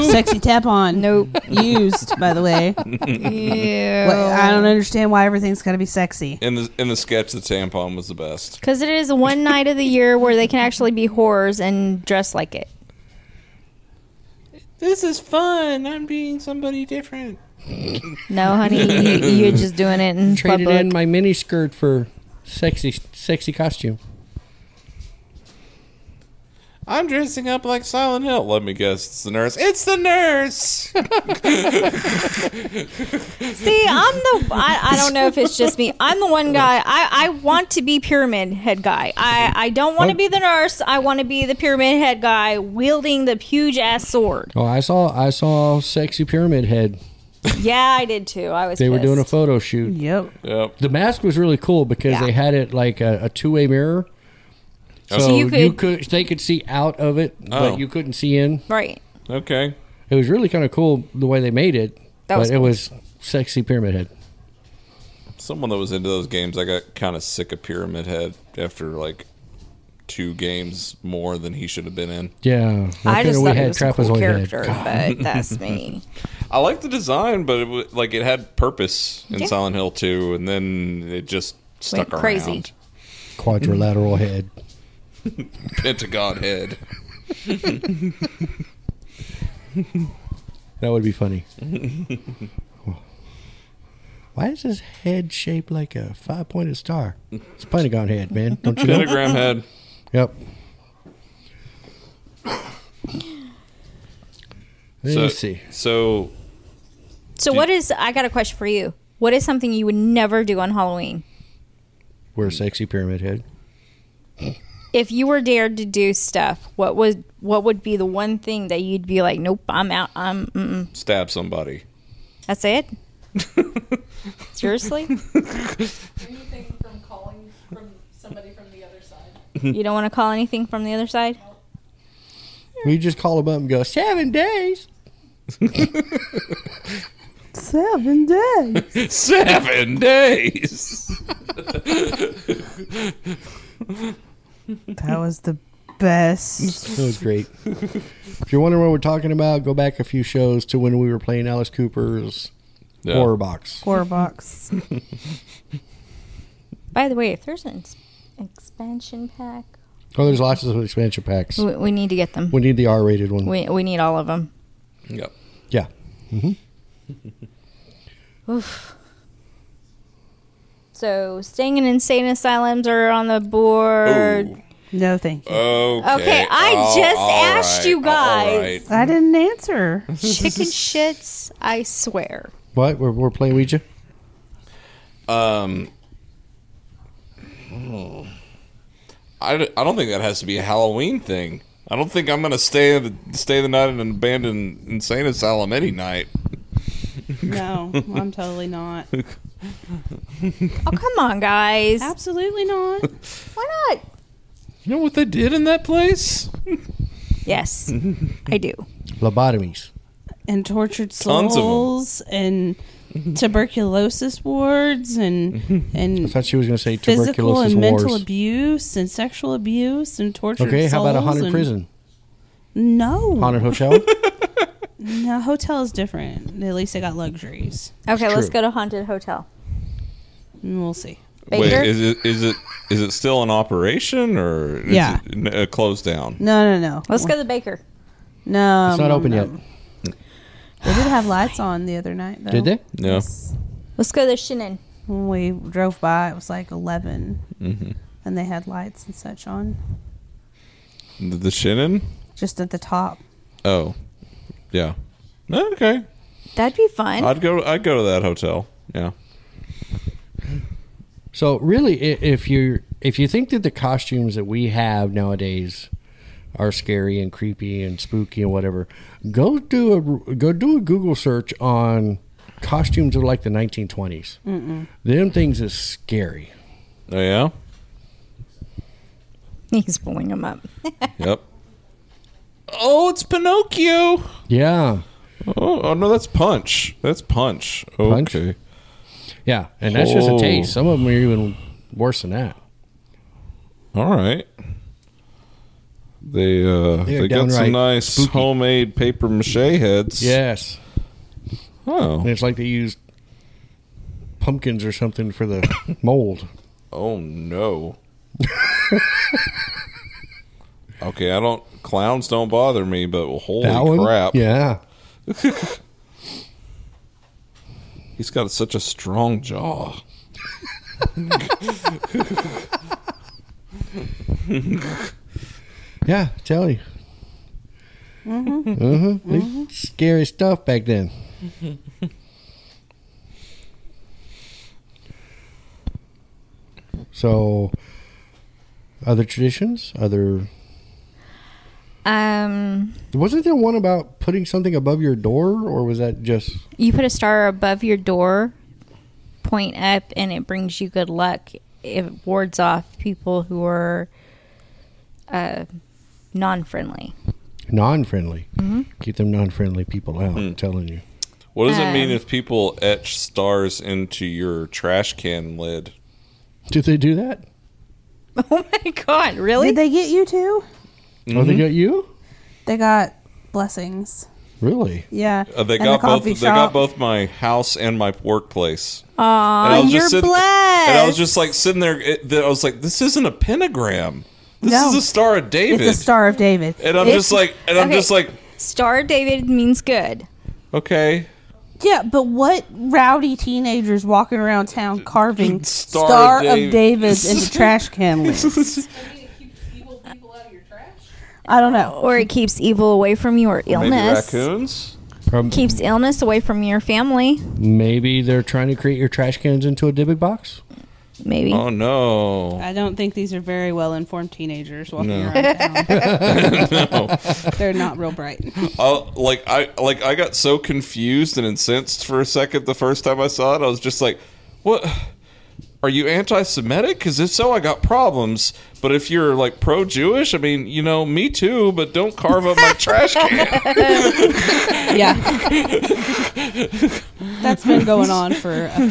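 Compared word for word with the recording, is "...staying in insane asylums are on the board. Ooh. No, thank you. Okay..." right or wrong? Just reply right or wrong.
right.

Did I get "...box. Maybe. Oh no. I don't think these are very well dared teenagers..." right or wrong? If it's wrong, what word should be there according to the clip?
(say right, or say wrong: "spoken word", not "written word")
wrong: "informed", not "dared".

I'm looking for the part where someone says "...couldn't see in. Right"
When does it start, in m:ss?
0:57.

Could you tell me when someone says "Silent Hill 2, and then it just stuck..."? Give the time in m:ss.
1:19.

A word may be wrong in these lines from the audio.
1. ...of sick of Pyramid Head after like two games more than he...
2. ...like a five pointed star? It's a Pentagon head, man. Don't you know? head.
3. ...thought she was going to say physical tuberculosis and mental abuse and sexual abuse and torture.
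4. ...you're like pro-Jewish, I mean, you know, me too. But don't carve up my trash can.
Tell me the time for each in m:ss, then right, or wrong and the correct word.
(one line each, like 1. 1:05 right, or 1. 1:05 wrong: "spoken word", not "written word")
1. 1:07 right
2. 1:35 right
3. 3:36 right
4. 7:09 right.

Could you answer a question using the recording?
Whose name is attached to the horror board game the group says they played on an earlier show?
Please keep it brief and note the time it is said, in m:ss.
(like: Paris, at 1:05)
Alice Cooper, at 2:31.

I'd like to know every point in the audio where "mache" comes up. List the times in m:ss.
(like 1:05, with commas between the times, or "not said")
4:59.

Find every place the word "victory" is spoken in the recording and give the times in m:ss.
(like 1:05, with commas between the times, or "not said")
not said.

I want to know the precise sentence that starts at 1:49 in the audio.
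What is something you would never do on Halloween?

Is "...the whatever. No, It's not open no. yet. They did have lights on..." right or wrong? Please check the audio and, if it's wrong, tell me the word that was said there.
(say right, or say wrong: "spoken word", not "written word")
wrong: "baker", not "whatever".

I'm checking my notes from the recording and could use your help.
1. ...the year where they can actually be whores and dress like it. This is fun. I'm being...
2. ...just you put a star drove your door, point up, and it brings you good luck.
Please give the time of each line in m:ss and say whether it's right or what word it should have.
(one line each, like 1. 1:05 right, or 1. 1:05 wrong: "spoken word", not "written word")
1. 0:09 right
2. 5:46 wrong: "above", not "drove".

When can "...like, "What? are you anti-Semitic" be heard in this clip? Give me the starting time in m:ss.
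7:04.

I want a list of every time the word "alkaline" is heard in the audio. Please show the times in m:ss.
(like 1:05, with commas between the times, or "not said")
not said.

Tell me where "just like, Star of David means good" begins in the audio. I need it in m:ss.
6:27.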